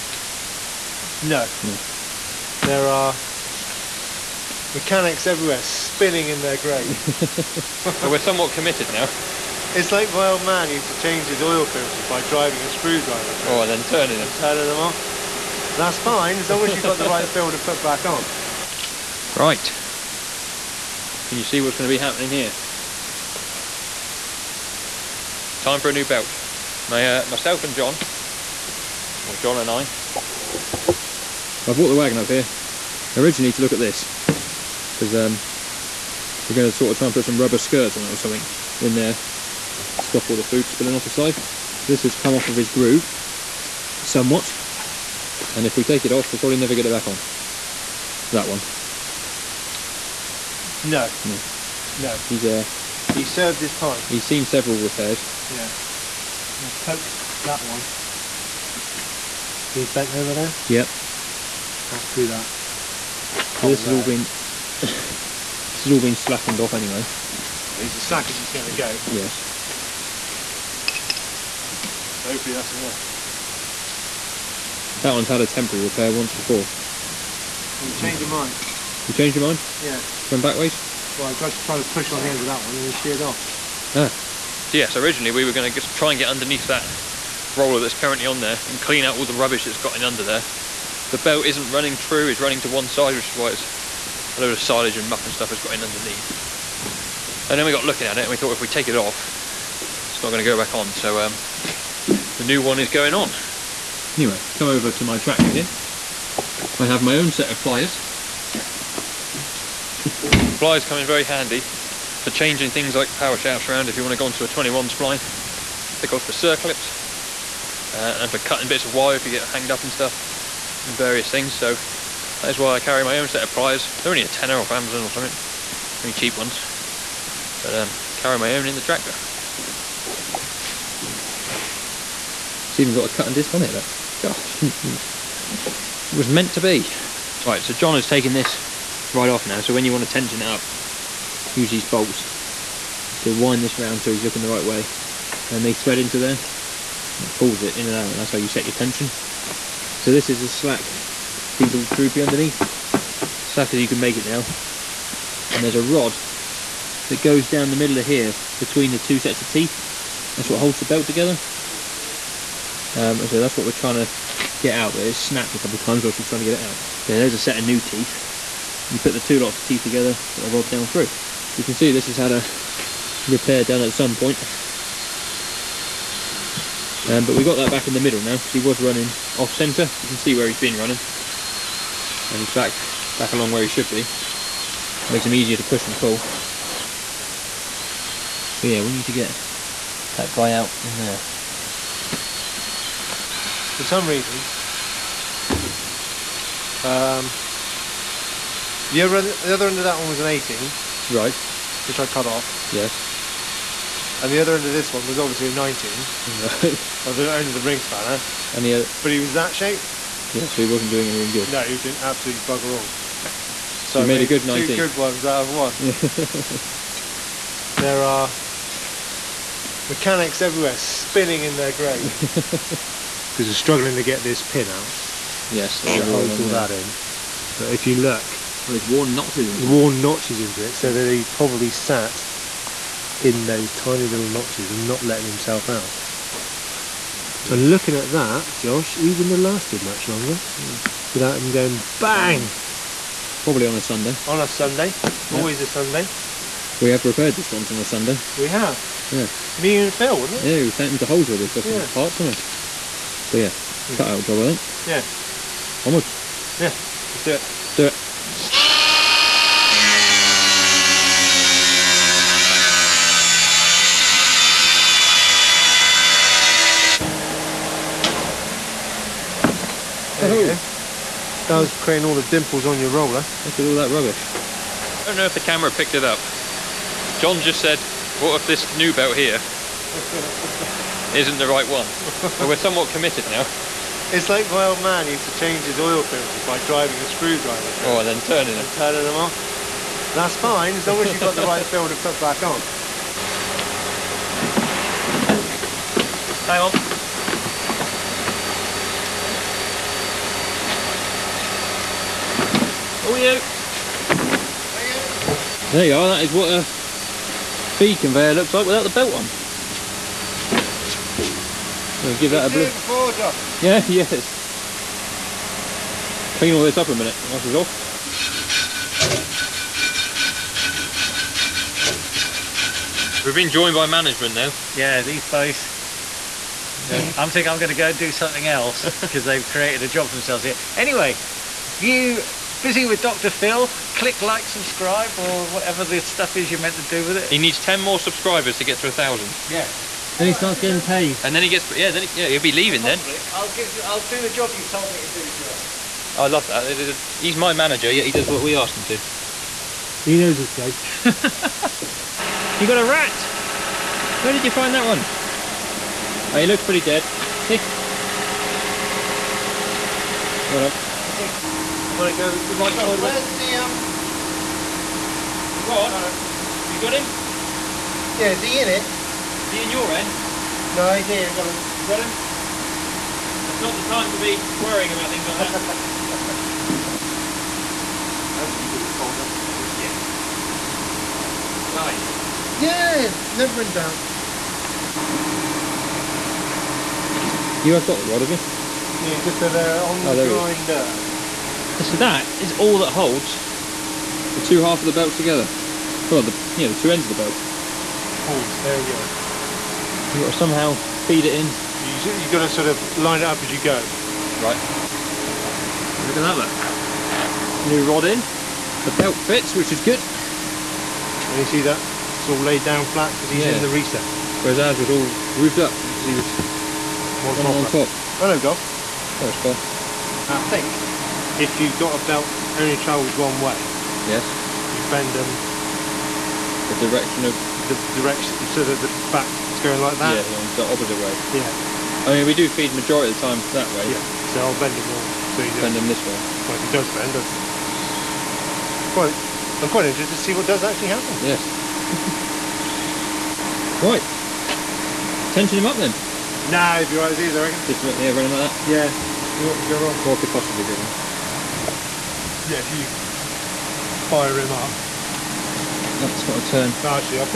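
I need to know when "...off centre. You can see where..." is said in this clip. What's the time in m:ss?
2:59.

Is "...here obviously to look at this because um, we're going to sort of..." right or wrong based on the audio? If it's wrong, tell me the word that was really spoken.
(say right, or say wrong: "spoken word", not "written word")
wrong: "originally", not "obviously".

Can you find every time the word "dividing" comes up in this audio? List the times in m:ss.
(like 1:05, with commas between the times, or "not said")
not said.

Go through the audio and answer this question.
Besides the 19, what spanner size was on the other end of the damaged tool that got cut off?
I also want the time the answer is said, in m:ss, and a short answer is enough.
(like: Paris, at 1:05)
18, at 3:20.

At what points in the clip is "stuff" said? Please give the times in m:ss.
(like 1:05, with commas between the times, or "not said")
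1:35, 1:59, 5:35.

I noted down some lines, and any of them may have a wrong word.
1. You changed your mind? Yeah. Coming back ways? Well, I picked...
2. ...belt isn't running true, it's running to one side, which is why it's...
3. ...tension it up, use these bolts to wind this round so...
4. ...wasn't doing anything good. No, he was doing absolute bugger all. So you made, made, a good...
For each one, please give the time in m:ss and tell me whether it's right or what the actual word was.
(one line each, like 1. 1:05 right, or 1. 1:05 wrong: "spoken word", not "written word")
1. 1:19 wrong: "tried", not "picked"
2. 1:31 right
3. 2:20 right
4. 3:30 right.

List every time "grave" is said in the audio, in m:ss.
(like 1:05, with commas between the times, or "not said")
0:06, 3:41.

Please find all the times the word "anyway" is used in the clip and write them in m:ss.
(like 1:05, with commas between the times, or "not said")
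1:06, 1:44, 5:30.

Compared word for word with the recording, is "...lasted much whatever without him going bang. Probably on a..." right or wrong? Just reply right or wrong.
wrong.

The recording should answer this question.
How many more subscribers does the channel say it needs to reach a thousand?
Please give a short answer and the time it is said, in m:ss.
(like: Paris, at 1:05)
10, at 5:37.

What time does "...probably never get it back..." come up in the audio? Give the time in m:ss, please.
0:46.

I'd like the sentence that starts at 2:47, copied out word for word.
Yeah, there's a set of new teeth.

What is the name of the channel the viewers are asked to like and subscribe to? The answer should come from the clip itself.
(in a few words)
Busy with Dr. Phil.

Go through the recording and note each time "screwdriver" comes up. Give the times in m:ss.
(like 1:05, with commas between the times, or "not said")
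0:12, 4:47.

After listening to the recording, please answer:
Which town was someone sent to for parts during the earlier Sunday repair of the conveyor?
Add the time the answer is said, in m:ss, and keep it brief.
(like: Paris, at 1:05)
Holsworthy, at 4:11.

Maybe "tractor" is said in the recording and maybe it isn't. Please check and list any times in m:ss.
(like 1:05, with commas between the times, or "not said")
1:45, 2:08.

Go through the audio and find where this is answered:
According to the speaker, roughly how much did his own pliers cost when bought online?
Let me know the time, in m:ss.
2:04.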